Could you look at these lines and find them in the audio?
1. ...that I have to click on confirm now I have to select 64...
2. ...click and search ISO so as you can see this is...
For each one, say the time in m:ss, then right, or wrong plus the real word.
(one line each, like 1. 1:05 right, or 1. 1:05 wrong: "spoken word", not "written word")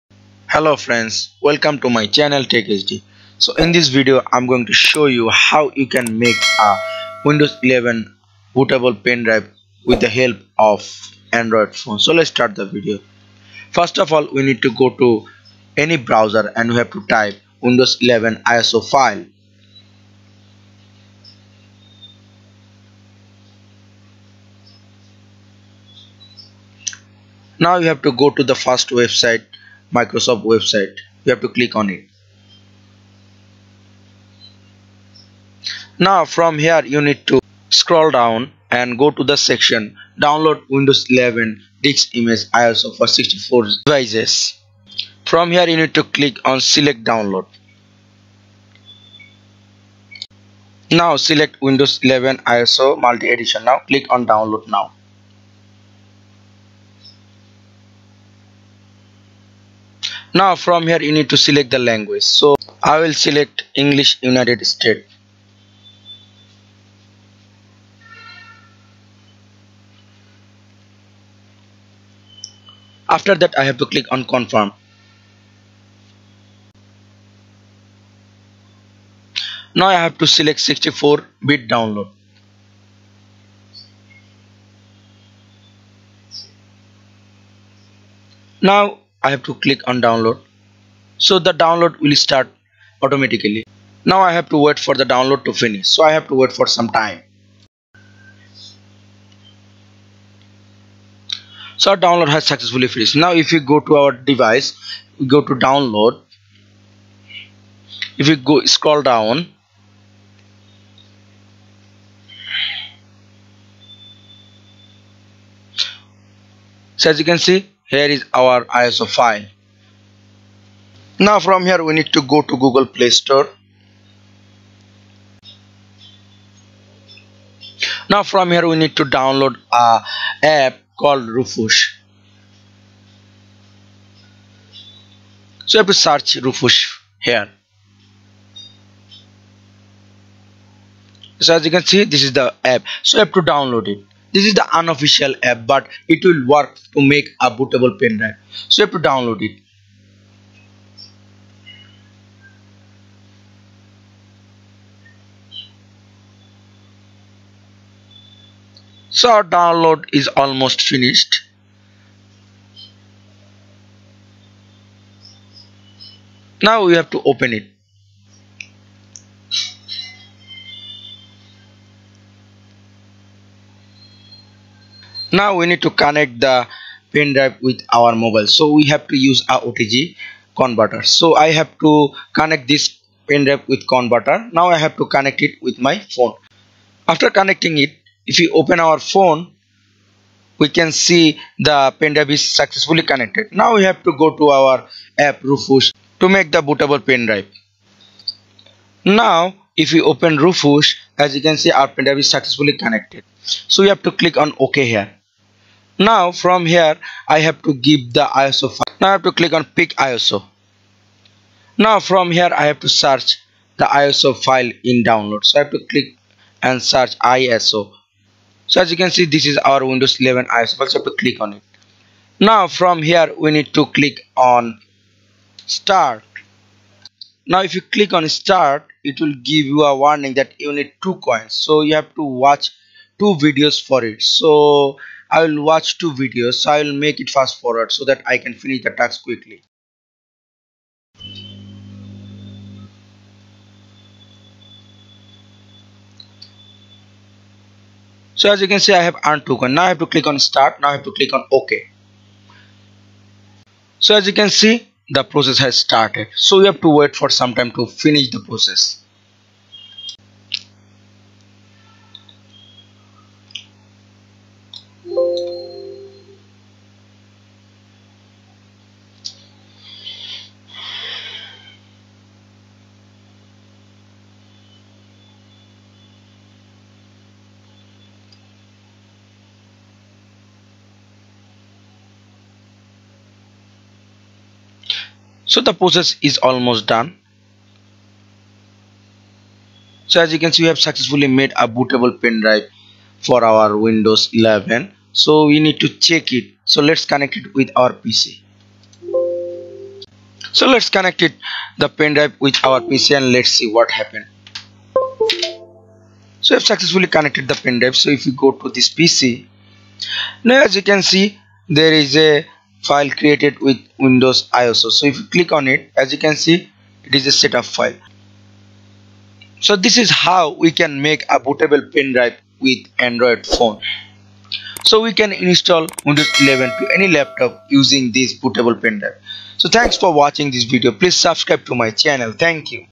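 1. 1:13 right
2. 3:35 right.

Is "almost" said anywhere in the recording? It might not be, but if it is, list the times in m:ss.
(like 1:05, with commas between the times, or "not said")
2:40, 4:46.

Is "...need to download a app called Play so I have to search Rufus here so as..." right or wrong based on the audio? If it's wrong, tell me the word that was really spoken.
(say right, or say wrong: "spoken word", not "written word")
wrong: "Rufus", not "Play".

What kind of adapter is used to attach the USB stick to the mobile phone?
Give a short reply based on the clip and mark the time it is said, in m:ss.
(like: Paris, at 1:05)
OTG converter, at 2:59.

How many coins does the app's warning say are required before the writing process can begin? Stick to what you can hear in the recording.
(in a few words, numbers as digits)
2.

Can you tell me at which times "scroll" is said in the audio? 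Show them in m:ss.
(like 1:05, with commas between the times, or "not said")
0:37, 1:48.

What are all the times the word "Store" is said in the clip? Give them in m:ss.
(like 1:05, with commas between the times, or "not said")
2:03.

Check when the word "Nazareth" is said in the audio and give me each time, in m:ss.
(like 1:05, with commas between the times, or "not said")
not said.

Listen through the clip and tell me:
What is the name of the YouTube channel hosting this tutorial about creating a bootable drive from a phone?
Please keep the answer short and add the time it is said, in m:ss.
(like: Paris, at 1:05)
TechHD, at 0:02.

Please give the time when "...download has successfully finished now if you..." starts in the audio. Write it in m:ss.
1:41.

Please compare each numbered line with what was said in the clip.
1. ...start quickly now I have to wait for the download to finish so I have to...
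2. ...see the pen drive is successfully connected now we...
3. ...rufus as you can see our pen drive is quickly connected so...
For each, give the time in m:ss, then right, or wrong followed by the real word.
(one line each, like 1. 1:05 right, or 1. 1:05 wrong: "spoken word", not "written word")
1. 1:32 wrong: "automatically", not "quickly"
2. 3:10 right
3. 3:20 wrong: "successfully", not "quickly".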